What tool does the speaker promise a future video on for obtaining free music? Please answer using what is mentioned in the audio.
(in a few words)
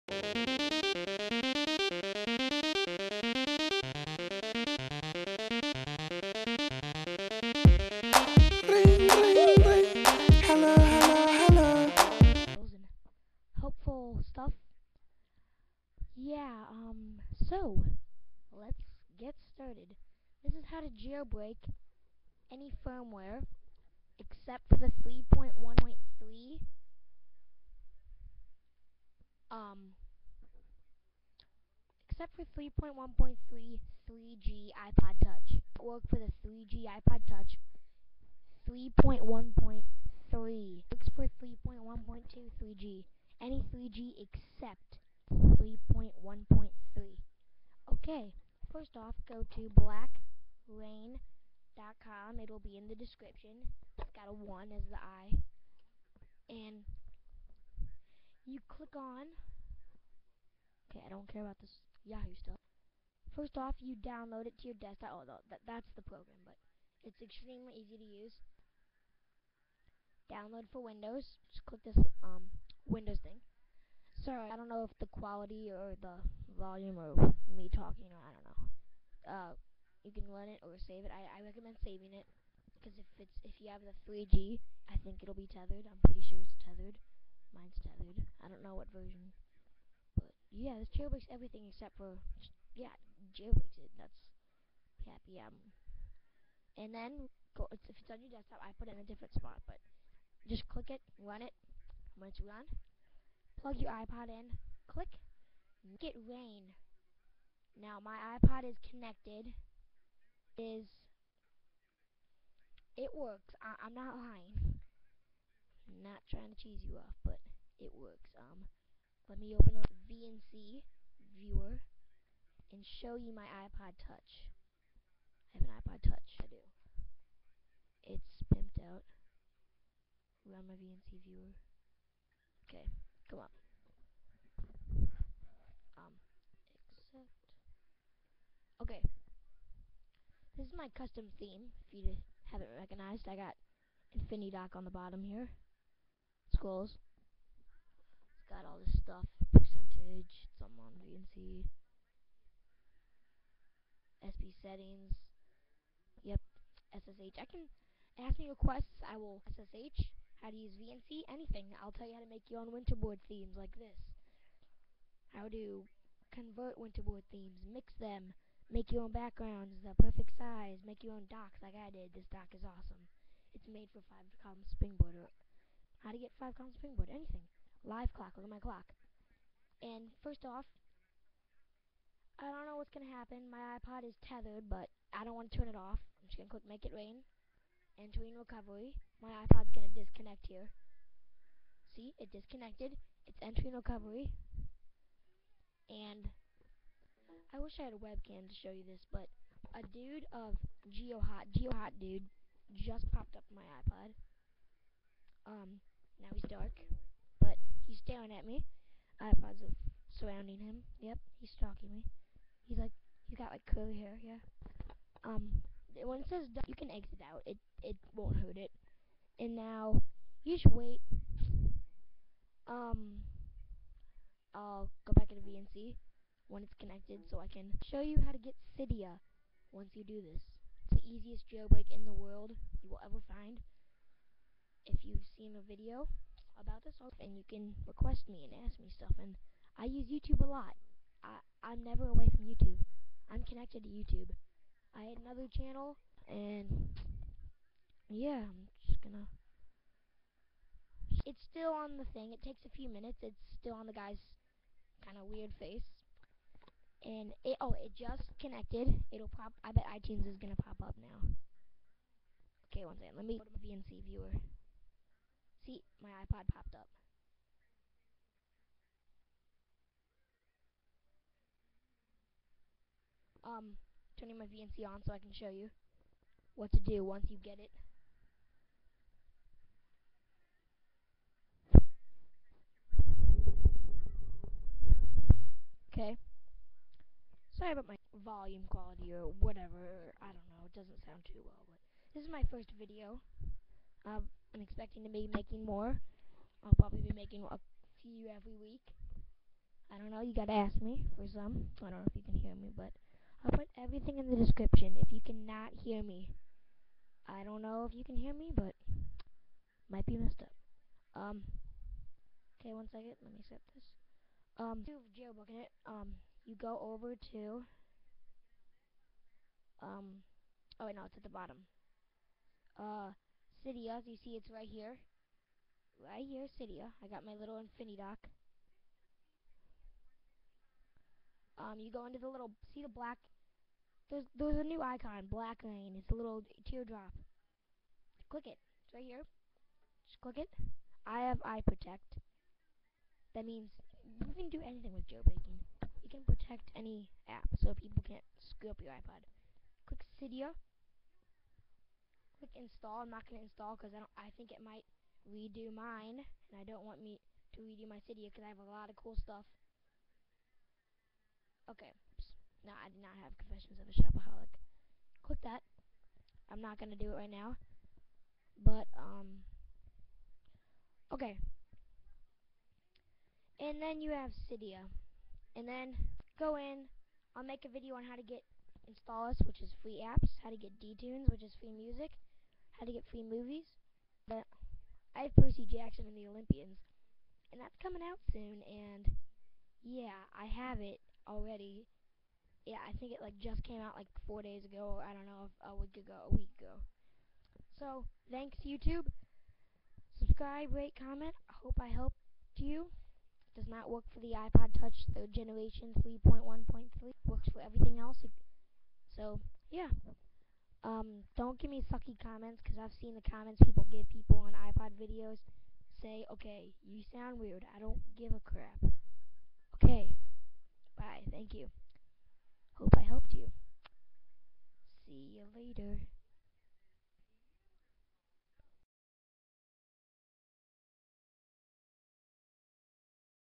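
D-Tunes.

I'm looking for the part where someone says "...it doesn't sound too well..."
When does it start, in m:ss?
4:50.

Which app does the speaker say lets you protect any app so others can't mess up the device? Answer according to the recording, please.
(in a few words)
iProtect.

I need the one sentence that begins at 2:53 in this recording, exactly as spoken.
It's made for five column springboard.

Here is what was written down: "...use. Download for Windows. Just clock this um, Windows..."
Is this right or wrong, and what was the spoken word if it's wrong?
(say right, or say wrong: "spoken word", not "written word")
wrong: "click", not "clock".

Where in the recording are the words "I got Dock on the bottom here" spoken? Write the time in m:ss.
2:23.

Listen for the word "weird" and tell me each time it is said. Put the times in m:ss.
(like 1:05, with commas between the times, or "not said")
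4:15, 6:57.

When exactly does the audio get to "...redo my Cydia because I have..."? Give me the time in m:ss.
5:57.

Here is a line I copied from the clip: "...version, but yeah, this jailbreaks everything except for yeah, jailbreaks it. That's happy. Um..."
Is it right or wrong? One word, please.
right.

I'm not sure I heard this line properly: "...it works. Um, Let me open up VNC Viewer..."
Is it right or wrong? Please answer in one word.
right.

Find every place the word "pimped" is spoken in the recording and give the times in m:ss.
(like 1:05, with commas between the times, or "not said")
2:08.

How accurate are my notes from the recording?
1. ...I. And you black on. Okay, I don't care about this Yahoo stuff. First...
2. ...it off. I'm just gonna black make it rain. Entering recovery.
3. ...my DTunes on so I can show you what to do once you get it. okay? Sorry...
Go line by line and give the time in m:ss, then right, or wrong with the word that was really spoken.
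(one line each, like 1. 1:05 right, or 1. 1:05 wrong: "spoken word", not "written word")
1. 0:54 wrong: "click", not "black"
2. 3:05 wrong: "click", not "black"
3. 4:34 wrong: "VNC", not "DTunes".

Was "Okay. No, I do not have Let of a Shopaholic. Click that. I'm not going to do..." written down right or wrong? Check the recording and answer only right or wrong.
wrong.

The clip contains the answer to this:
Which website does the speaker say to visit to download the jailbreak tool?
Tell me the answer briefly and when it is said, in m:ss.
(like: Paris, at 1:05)
blackra1n.com, at 0:49.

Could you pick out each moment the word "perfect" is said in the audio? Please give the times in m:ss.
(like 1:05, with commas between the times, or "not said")
2:50.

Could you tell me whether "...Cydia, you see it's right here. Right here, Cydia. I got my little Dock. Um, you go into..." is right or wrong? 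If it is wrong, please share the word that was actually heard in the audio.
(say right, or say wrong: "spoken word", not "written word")
right.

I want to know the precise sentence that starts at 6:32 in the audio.
Yeah, I think it like just came out like four days ago, I don't know, a week ago, a week ago.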